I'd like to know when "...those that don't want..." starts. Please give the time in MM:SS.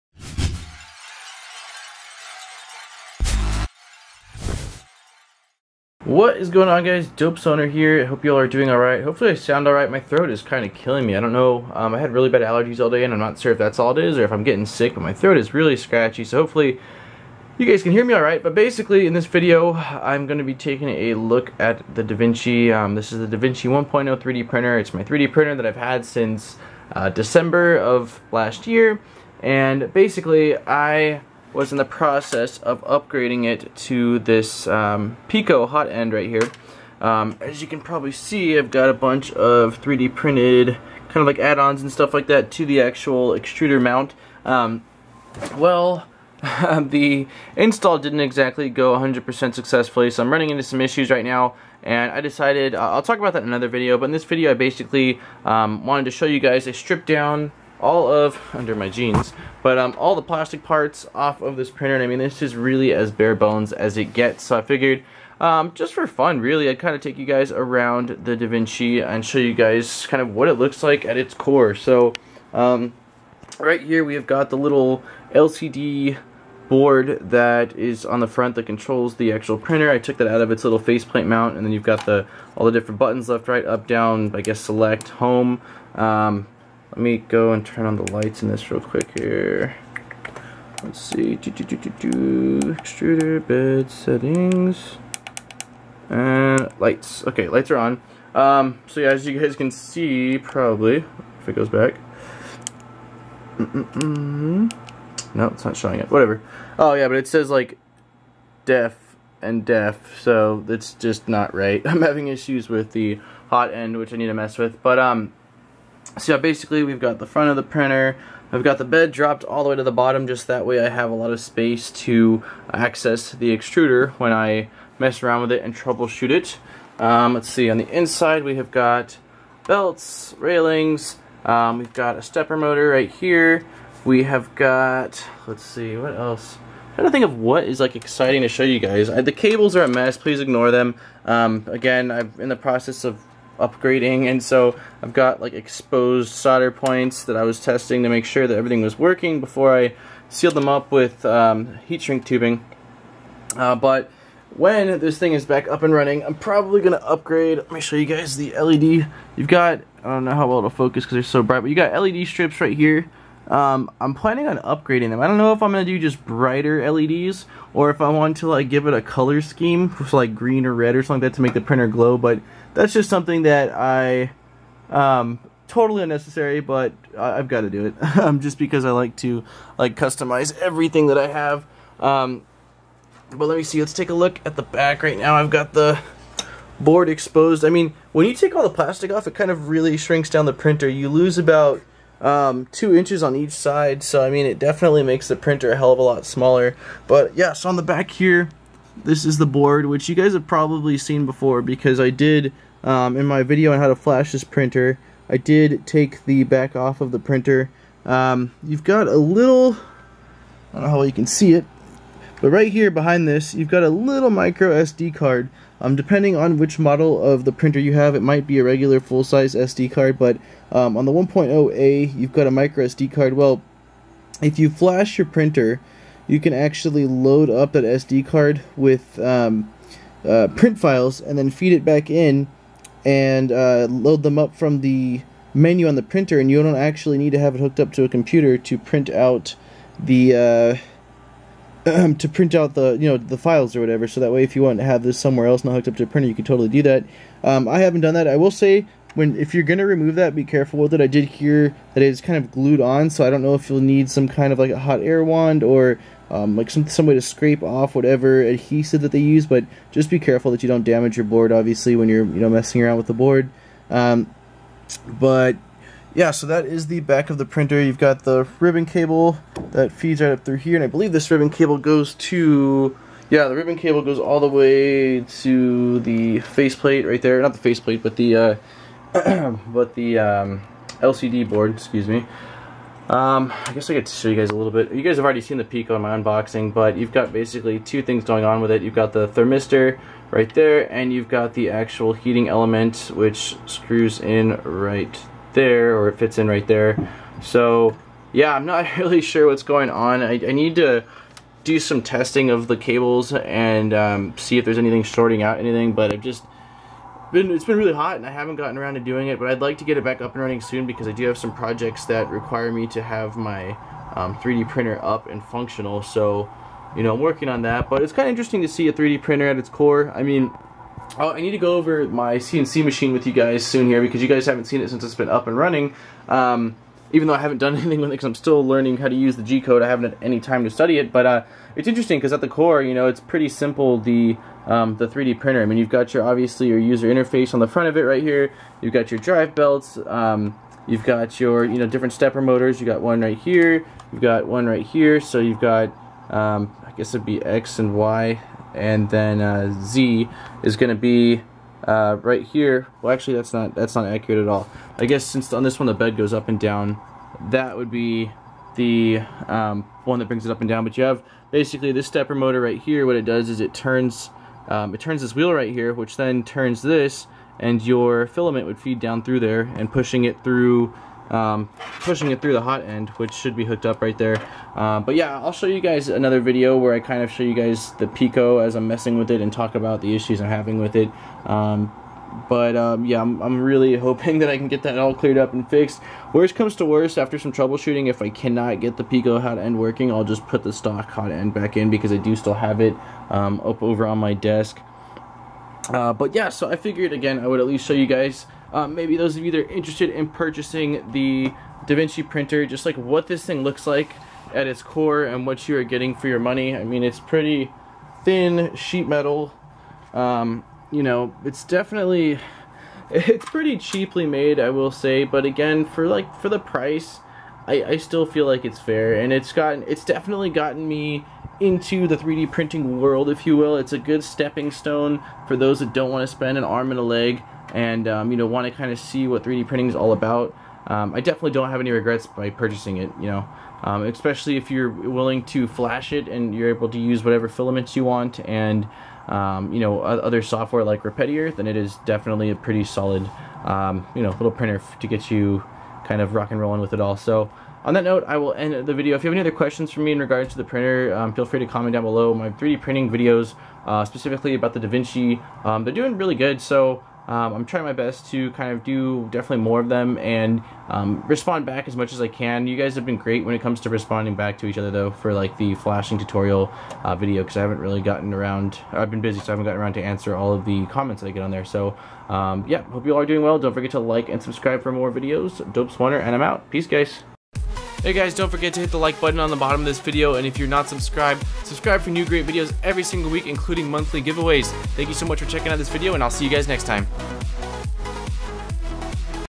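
07:05.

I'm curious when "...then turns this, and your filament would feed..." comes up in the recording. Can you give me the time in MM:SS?
06:06.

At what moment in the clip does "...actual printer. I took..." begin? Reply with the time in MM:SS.
01:19.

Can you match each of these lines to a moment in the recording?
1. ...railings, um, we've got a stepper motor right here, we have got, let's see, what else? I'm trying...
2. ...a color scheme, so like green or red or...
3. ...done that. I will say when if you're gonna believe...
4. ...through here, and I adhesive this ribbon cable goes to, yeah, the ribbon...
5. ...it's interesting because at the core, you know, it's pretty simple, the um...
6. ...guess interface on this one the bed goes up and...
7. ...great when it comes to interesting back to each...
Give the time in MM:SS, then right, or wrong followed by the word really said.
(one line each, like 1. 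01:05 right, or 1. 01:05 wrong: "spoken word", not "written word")
1. 02:10 right
2. 02:48 right
3. 04:08 wrong: "remove", not "believe"
4. 04:30 wrong: "believe", not "adhesive"
5. 05:31 right
6. 05:55 wrong: "since", not "interface"
7. 07:43 wrong: "responding", not "interesting".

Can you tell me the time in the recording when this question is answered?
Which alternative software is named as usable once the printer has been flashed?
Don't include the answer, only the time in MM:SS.
07:21.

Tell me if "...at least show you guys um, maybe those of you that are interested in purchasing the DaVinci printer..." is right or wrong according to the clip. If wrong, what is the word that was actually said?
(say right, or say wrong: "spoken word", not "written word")
right.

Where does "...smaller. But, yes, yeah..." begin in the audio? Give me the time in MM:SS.
03:16.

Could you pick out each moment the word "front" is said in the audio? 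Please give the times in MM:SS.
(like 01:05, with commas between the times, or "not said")
01:18, 01:57, 05:37.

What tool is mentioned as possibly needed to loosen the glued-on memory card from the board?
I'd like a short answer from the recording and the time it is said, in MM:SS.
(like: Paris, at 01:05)
hot air wand, at 04:14.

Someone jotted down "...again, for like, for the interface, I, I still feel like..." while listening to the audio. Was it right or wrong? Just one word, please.
wrong.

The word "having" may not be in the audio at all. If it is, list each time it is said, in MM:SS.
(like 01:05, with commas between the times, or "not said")
01:52, 06:20.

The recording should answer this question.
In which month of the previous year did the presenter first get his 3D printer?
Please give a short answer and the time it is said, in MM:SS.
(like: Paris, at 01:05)
December, at 00:27.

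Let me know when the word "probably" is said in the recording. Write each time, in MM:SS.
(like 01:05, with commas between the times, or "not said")
00:37, 01:40, 02:36, 03:20.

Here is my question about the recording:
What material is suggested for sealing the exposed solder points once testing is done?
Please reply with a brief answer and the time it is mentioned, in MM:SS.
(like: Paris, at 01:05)
heat shrink tubing, at 02:31.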